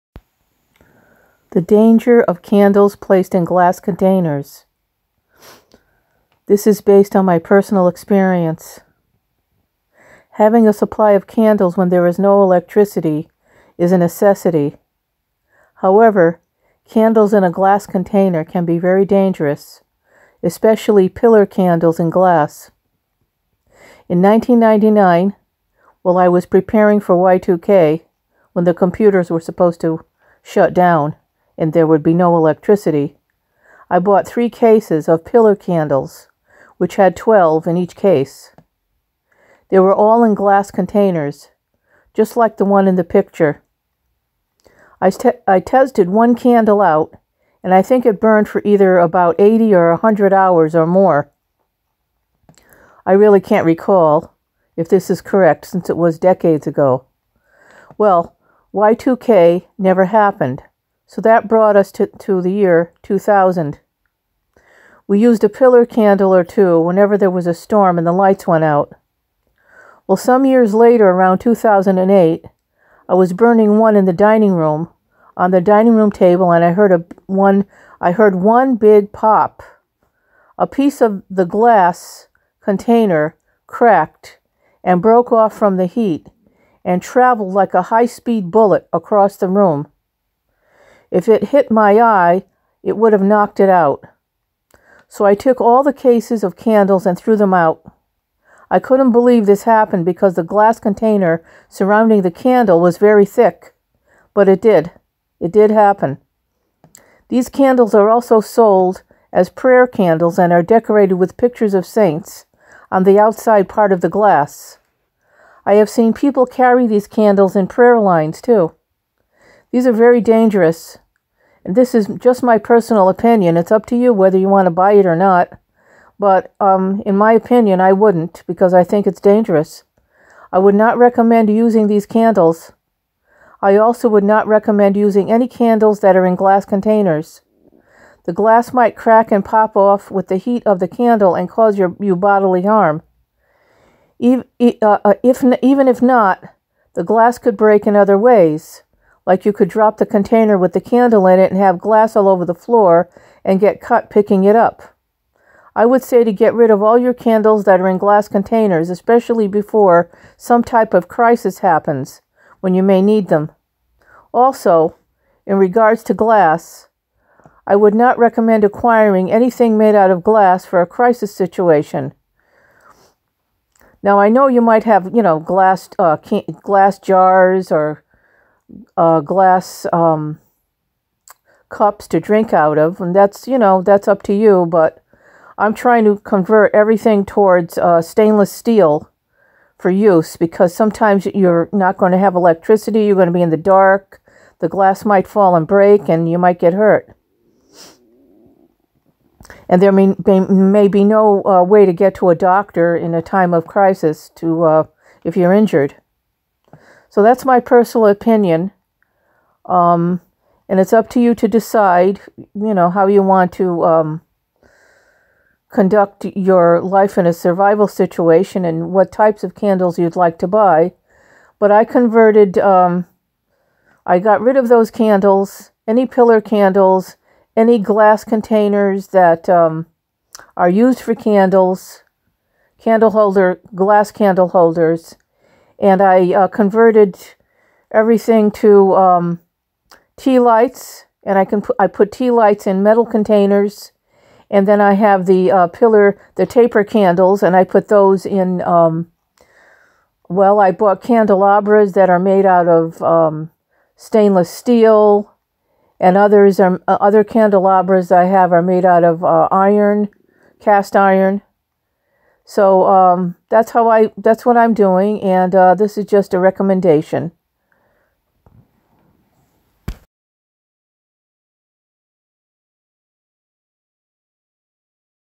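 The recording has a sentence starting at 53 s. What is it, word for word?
I really can't recall if this is correct since it was decades ago.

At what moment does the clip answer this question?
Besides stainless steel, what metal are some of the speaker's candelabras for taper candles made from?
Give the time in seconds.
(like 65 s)
260 s.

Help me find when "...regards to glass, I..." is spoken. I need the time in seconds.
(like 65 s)
165 s.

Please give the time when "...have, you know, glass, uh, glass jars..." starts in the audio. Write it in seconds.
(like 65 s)
174 s.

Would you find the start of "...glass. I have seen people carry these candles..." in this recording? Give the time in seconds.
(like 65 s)
114 s.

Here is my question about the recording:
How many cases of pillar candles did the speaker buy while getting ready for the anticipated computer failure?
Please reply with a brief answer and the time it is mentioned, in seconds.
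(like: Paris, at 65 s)
3, at 34 s.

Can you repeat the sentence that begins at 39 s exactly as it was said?
They were all in glass containers, just like the one in the picture.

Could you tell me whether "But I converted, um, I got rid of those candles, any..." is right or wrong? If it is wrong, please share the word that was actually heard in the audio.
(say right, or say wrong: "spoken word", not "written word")
right.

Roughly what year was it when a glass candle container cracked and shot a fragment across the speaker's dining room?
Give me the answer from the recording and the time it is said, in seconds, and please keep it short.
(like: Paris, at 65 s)
2008, at 71 s.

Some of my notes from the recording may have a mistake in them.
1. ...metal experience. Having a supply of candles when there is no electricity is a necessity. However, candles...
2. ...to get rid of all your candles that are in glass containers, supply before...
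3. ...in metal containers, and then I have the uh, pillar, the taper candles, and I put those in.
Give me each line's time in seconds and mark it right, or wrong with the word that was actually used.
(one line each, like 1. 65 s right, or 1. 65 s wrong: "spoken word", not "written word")
1. 7 s wrong: "personal", not "metal"
2. 156 s wrong: "especially", not "supply"
3. 242 s right.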